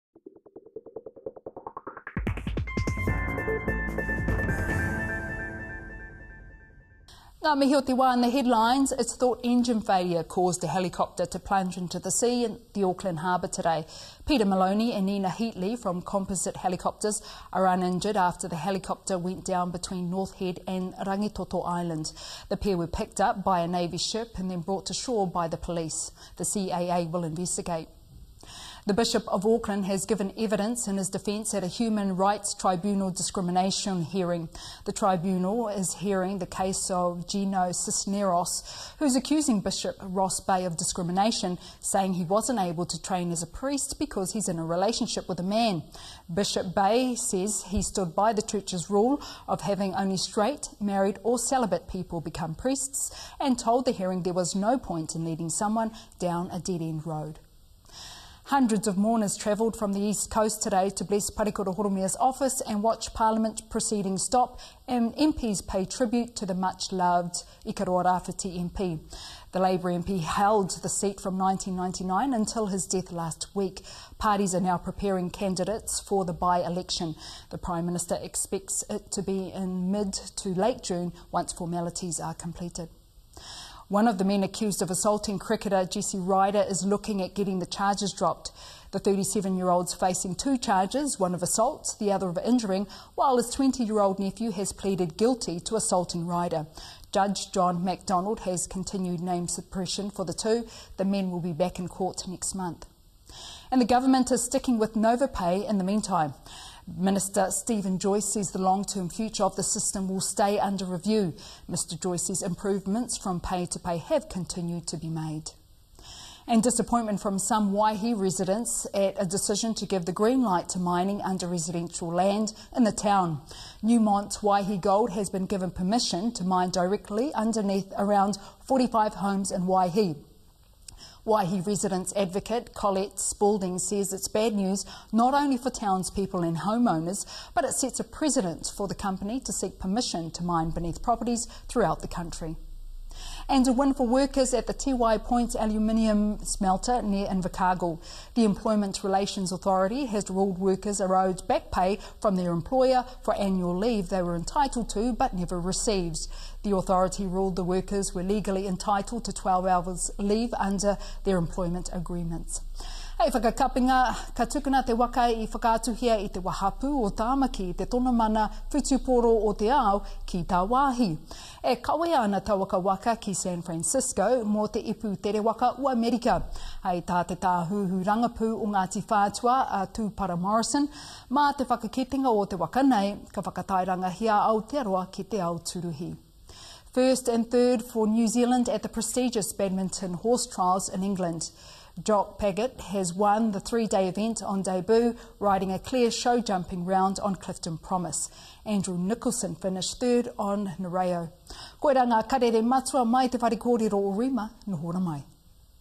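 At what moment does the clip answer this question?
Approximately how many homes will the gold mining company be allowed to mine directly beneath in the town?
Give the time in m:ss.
2:08.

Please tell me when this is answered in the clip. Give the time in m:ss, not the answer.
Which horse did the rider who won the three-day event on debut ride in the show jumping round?
3:17.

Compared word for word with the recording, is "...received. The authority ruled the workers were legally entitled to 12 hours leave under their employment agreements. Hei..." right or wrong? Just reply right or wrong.
right.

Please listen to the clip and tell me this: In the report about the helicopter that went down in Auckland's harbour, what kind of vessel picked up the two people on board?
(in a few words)
Navy ship.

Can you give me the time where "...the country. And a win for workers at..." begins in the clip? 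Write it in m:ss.
2:22.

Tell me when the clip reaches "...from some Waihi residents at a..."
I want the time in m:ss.
1:57.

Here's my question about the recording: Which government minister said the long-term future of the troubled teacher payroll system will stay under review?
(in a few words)
Steven Joyce.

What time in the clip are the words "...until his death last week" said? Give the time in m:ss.
1:12.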